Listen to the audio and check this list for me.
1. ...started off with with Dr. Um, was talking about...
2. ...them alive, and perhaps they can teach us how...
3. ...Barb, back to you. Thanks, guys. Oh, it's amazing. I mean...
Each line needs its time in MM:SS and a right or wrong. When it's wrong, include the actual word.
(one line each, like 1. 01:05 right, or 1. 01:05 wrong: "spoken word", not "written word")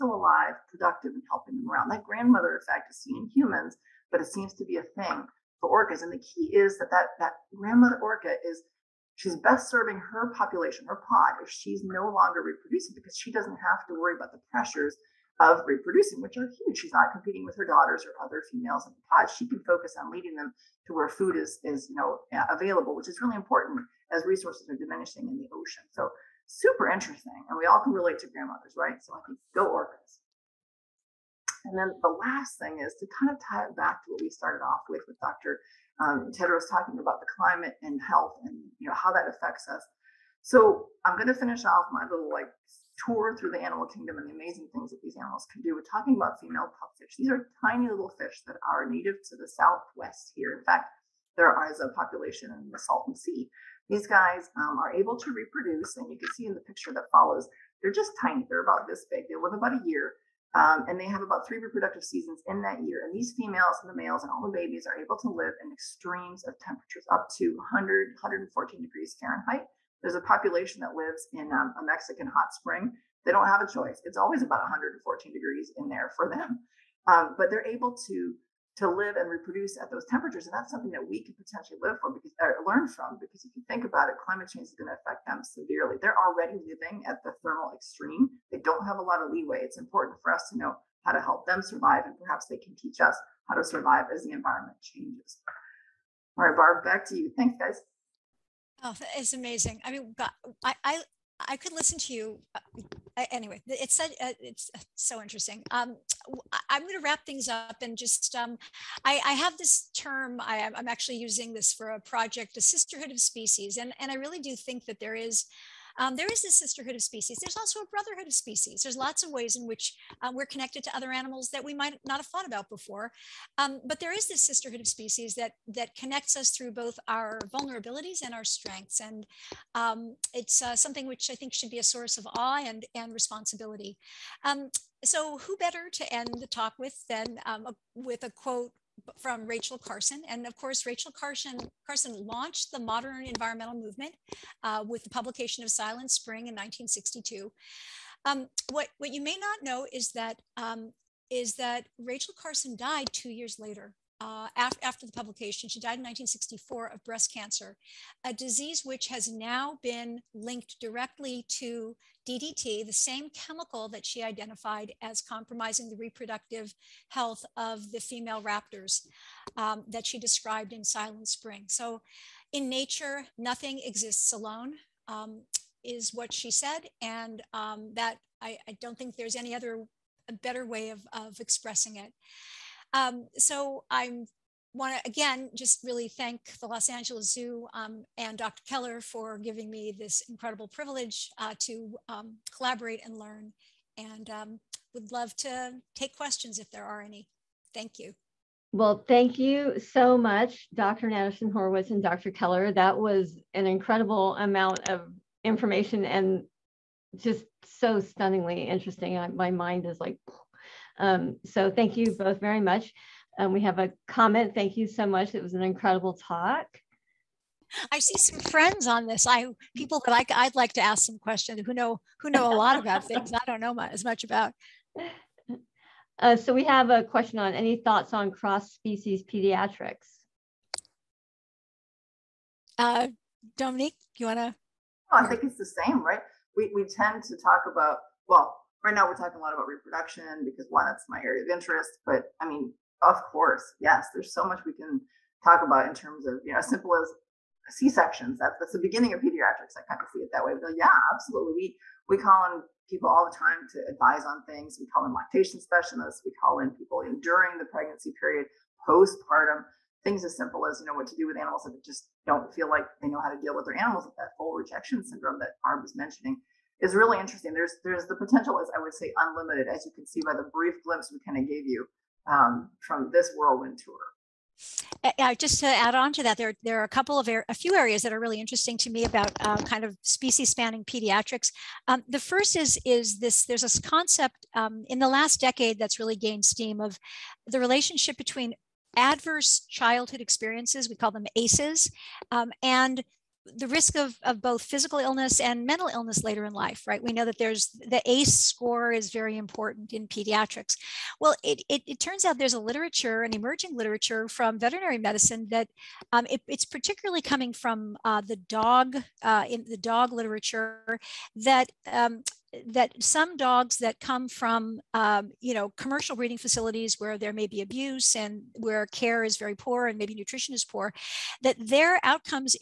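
1. 00:34 right
2. 01:31 wrong: "survive", not "alive"
3. 01:36 right.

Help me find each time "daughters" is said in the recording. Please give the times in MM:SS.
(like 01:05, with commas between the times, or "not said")
00:17.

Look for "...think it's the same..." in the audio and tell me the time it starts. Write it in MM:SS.
03:55.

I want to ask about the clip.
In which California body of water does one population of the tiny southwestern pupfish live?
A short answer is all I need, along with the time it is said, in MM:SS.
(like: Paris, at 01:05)
Salton Sea, at 00:52.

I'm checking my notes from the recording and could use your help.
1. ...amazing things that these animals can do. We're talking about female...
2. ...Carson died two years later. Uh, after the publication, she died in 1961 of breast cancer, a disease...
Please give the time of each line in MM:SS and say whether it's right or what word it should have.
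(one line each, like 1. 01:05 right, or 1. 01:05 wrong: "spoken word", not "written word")
1. 00:44 right
2. 02:32 wrong: "1964", not "1961".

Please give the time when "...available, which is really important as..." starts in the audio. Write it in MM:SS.
00:22.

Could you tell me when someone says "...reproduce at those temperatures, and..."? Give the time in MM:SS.
01:19.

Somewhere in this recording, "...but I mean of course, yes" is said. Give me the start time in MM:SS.
04:02.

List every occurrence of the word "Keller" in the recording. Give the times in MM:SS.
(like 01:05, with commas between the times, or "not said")
03:08, 03:22.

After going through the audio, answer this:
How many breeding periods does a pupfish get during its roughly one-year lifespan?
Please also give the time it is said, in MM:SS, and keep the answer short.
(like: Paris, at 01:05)
3, at 01:01.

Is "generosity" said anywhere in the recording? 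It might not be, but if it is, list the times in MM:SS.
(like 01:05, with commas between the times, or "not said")
not said.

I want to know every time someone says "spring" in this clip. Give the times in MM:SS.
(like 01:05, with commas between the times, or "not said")
01:12, 02:26, 02:51.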